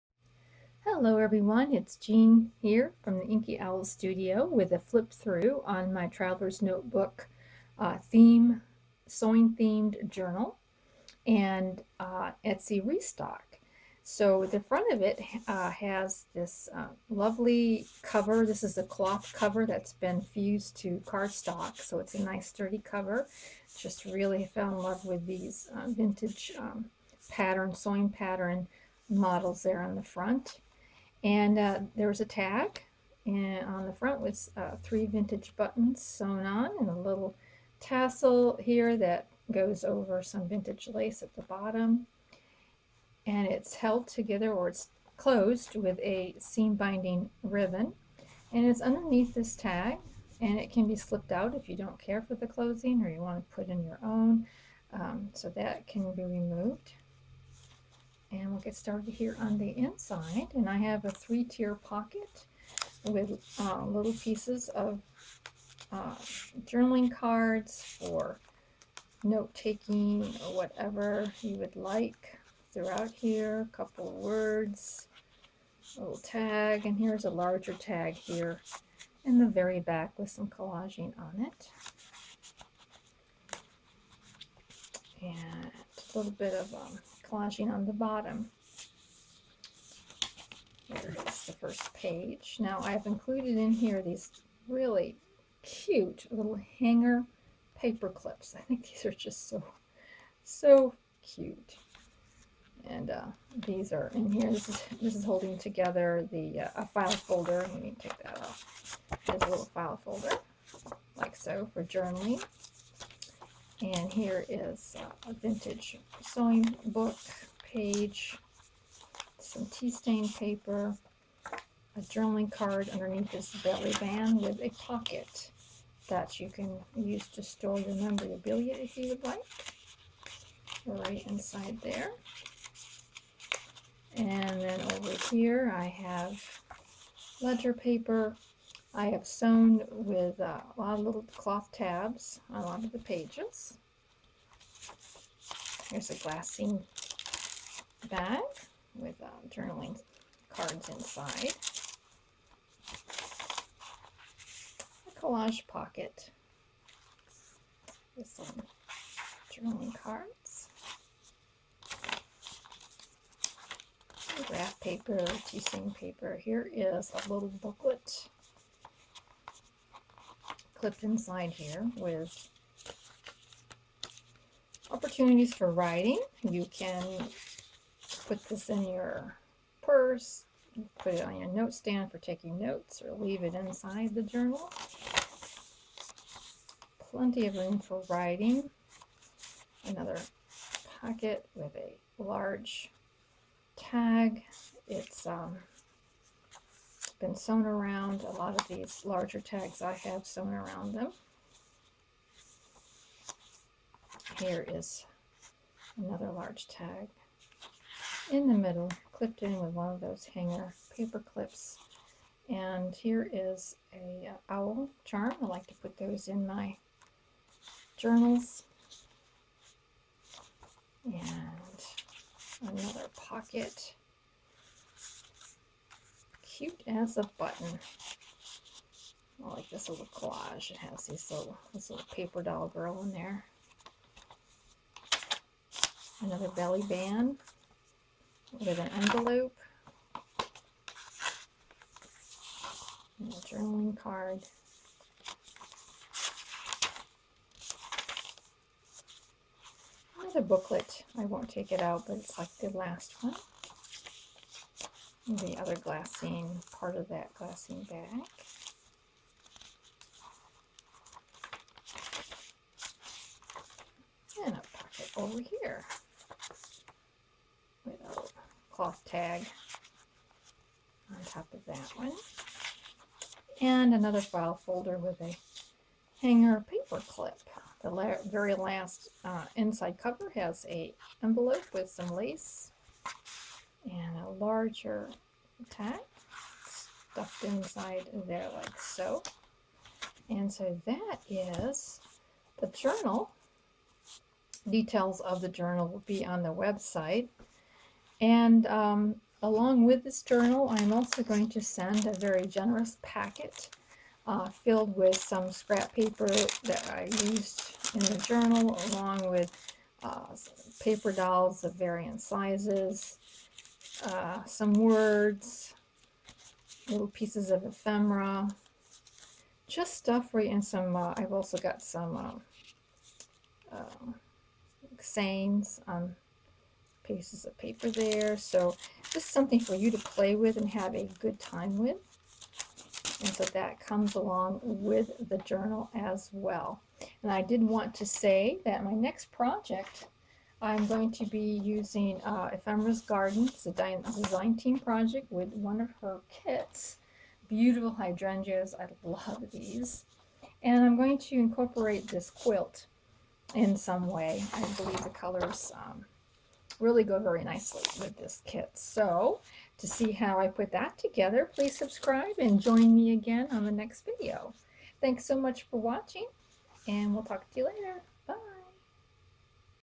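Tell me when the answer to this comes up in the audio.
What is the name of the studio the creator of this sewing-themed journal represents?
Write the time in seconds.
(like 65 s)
3 s.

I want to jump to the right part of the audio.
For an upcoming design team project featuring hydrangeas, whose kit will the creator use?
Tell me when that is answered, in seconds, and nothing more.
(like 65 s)
342 s.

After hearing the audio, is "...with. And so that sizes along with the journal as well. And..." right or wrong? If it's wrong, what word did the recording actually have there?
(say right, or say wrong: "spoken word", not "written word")
wrong: "comes", not "sizes".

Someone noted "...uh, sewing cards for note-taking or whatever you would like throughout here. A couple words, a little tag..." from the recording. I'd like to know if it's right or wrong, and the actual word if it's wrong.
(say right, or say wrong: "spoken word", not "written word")
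wrong: "journaling", not "sewing".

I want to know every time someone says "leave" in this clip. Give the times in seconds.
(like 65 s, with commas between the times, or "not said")
183 s.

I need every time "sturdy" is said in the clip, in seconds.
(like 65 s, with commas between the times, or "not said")
22 s.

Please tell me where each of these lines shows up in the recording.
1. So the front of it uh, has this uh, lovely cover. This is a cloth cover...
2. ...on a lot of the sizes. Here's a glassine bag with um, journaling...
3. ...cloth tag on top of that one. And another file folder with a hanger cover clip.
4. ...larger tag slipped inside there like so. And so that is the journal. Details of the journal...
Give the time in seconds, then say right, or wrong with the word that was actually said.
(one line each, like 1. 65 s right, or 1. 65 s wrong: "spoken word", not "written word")
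1. 14 s right
2. 142 s wrong: "pages", not "sizes"
3. 268 s wrong: "paper", not "cover"
4. 284 s wrong: "stuffed", not "slipped".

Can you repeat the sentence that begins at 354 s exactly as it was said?
I believe the colors um, really go very nicely with this kit.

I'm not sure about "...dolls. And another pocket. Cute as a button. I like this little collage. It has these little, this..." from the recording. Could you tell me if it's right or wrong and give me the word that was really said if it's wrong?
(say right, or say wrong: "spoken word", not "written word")
wrong: "journals", not "dolls".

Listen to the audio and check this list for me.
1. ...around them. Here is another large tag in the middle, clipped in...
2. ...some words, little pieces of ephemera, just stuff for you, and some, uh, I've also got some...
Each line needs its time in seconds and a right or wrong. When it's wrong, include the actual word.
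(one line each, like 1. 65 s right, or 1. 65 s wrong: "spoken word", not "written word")
1. 200 s right
2. 314 s right.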